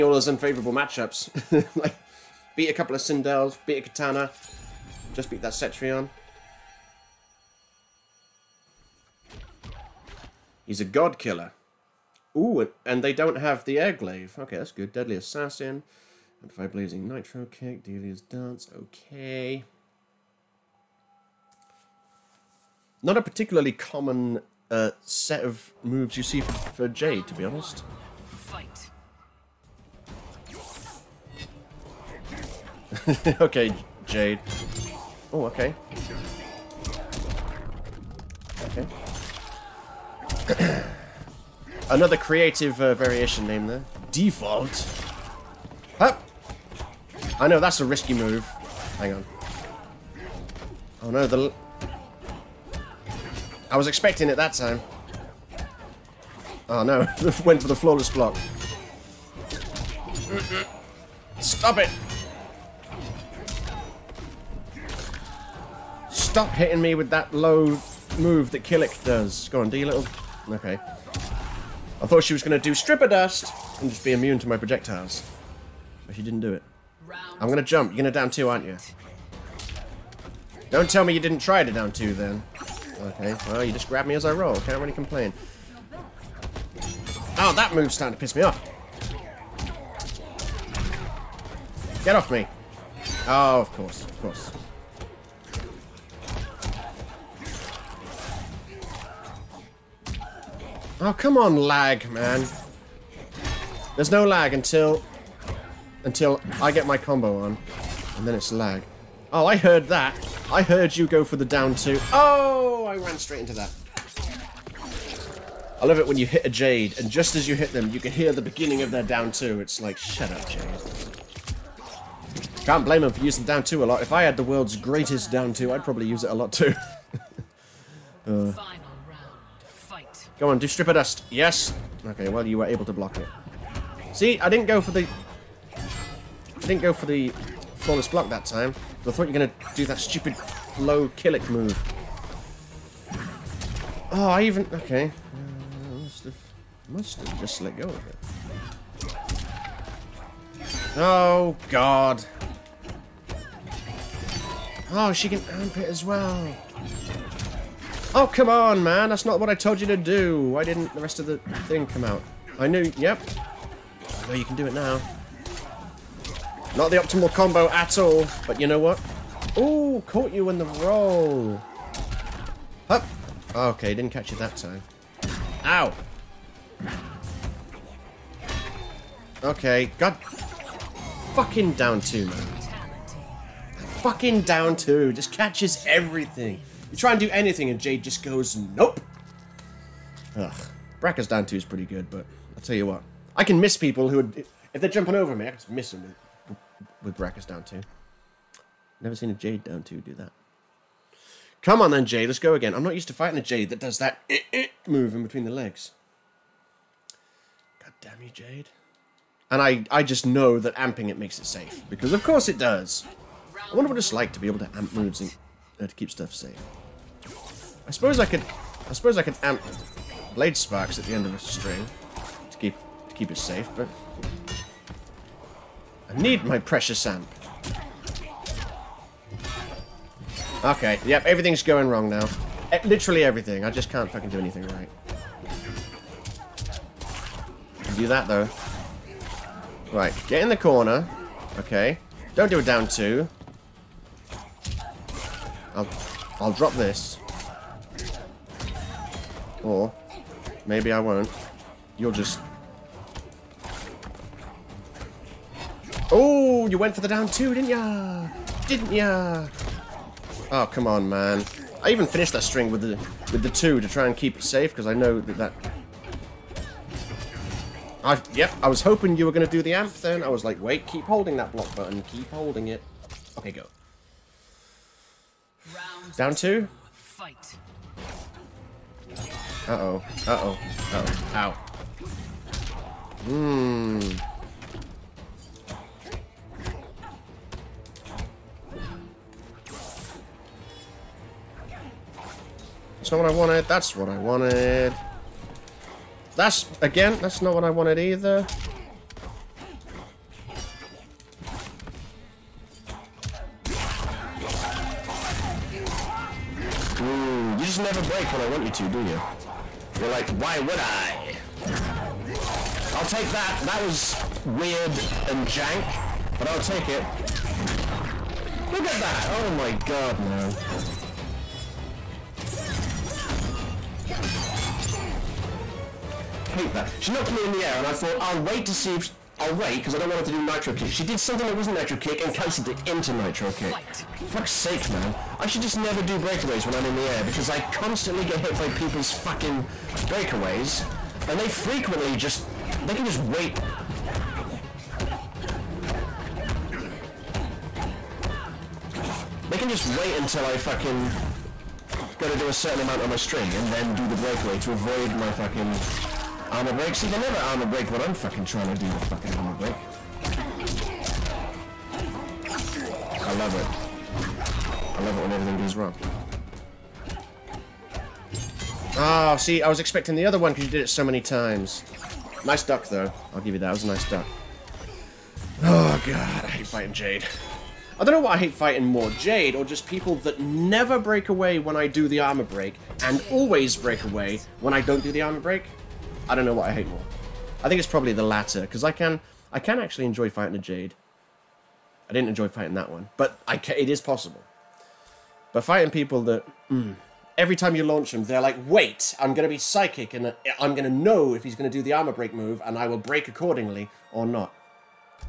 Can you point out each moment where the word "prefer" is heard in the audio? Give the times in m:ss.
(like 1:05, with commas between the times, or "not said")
not said.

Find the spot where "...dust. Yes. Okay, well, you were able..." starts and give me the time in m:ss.
2:10.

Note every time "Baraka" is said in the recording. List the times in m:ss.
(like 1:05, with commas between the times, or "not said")
3:10, 3:17.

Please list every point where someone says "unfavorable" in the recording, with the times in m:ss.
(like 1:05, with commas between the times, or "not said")
0:00.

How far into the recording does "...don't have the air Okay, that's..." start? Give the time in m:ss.
0:13.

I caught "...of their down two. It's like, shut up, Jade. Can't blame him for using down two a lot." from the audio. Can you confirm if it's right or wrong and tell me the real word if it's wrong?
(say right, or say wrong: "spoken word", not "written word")
right.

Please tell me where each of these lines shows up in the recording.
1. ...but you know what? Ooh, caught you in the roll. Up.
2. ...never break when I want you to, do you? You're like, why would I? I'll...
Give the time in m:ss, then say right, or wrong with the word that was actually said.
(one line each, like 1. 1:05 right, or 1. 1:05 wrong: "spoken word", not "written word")
1. 2:48 right
2. 5:07 right.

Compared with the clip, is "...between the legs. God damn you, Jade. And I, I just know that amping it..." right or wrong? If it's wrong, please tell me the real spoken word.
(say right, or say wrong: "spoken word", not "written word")
right.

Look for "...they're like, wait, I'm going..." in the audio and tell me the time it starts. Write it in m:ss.
6:38.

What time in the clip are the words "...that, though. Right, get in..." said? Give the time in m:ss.
3:58.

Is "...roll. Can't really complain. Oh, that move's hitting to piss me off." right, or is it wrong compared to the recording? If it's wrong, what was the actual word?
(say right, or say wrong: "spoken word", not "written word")
wrong: "starting", not "hitting".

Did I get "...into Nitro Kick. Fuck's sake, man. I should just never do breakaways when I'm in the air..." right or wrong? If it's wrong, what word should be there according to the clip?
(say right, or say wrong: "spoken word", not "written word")
right.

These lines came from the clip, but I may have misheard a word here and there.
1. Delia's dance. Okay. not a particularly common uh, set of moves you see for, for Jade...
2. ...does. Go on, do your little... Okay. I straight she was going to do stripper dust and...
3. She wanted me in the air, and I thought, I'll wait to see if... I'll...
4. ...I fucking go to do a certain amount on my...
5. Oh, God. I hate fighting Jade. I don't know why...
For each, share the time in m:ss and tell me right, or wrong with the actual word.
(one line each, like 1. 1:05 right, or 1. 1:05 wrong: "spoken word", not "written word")
1. 0:17 right
2. 1:09 wrong: "thought", not "straight"
3. 5:26 wrong: "knocked", not "wanted"
4. 5:50 right
5. 6:15 right.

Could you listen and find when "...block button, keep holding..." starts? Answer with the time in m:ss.
4:31.